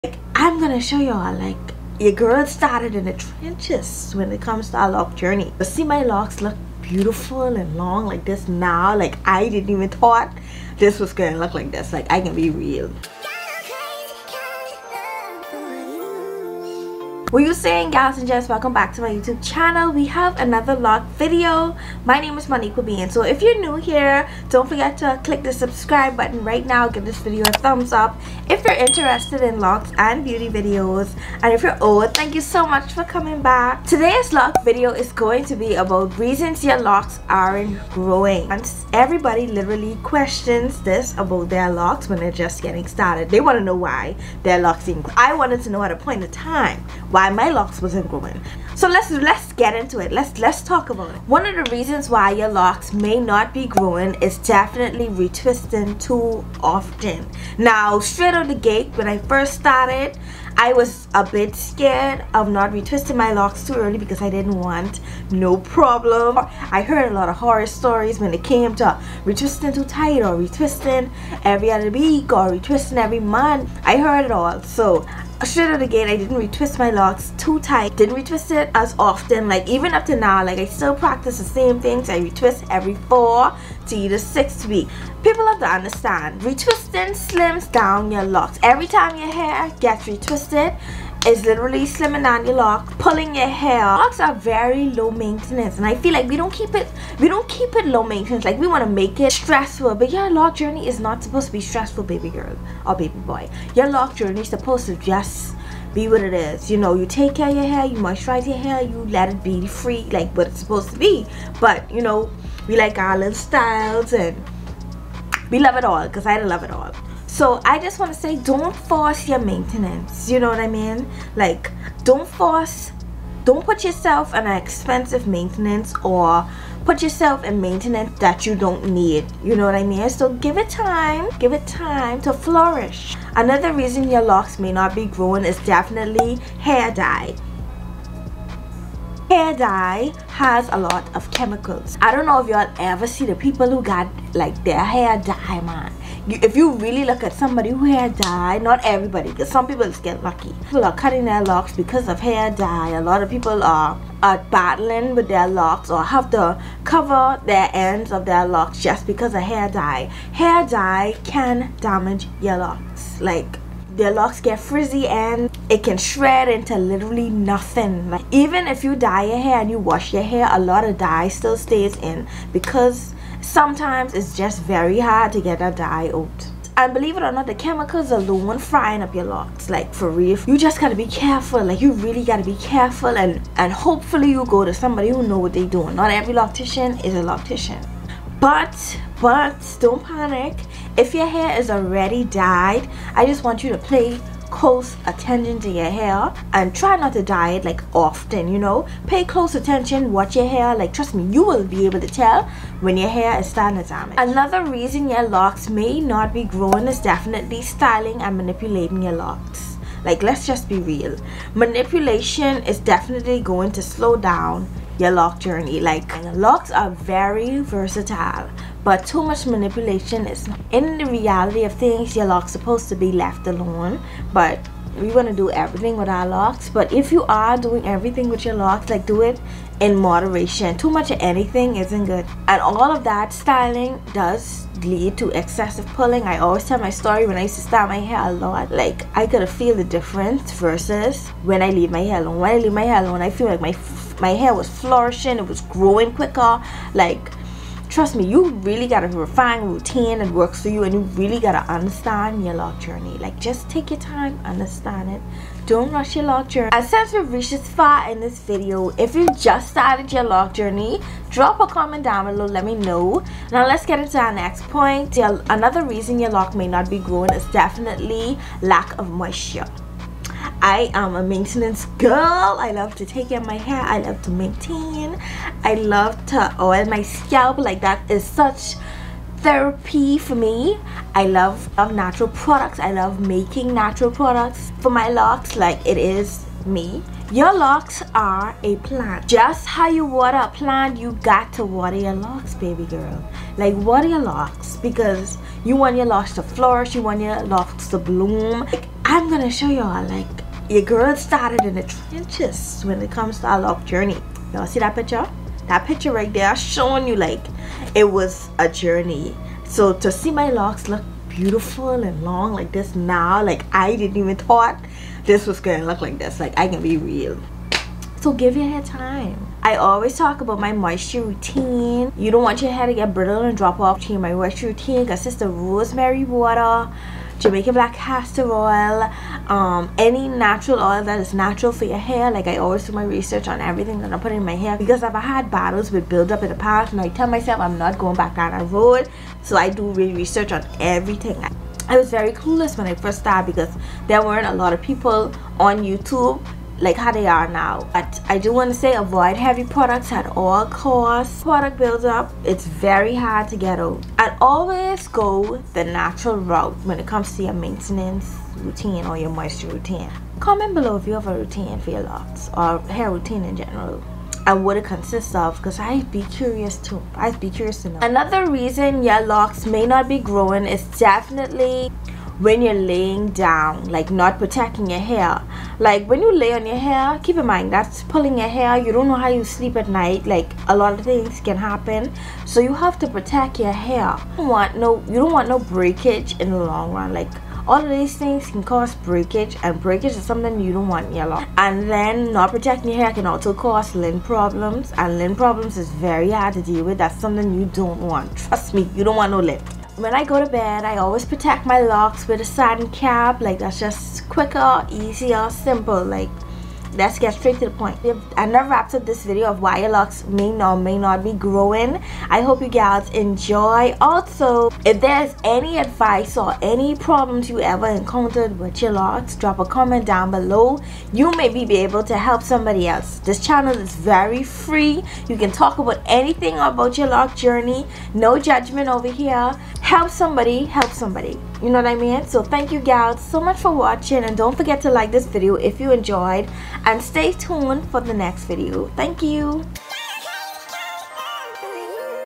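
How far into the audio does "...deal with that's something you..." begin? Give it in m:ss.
6:36.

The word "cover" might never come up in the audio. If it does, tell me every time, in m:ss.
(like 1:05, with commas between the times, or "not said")
2:36.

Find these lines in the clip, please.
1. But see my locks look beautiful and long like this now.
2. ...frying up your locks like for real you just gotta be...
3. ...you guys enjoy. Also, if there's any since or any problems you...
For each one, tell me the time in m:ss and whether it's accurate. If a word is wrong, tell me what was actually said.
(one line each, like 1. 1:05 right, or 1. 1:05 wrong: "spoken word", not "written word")
1. 0:05 right
2. 2:58 right
3. 6:52 wrong: "advice", not "since".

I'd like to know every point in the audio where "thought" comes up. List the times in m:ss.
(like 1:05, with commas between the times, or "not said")
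0:09, 5:14.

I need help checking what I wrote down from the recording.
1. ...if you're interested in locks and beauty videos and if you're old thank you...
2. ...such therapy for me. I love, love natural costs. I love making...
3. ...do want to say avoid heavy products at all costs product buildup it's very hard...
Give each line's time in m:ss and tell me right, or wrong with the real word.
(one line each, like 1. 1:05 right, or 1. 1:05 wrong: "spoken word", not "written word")
1. 0:28 right
2. 4:38 wrong: "products", not "costs"
3. 5:48 right.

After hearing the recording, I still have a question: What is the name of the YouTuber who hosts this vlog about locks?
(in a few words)
Moniqua Bain.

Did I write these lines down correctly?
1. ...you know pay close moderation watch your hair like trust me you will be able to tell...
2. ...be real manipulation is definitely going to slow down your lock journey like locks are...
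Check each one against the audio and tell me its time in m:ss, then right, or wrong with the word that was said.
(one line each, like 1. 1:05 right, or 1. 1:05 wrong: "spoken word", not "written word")
1. 3:18 wrong: "attention", not "moderation"
2. 3:30 right.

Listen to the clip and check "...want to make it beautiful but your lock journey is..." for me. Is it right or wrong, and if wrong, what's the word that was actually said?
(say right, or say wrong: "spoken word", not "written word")
wrong: "stressful", not "beautiful".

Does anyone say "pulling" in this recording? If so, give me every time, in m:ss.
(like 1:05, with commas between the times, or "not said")
1:32, 3:55, 6:18.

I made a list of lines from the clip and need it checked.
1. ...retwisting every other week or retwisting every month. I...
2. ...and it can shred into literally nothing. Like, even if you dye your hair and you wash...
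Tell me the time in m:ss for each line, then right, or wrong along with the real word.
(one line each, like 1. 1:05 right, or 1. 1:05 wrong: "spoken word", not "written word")
1. 1:10 right
2. 2:45 right.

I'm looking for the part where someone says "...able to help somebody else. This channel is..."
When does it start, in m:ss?
7:01.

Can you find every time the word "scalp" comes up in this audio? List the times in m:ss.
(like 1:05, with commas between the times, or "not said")
4:37.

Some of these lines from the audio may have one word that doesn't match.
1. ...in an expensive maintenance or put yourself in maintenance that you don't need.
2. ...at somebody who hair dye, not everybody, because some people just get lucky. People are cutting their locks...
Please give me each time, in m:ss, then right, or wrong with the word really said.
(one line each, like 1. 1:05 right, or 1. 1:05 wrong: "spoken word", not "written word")
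1. 2:04 right
2. 2:27 right.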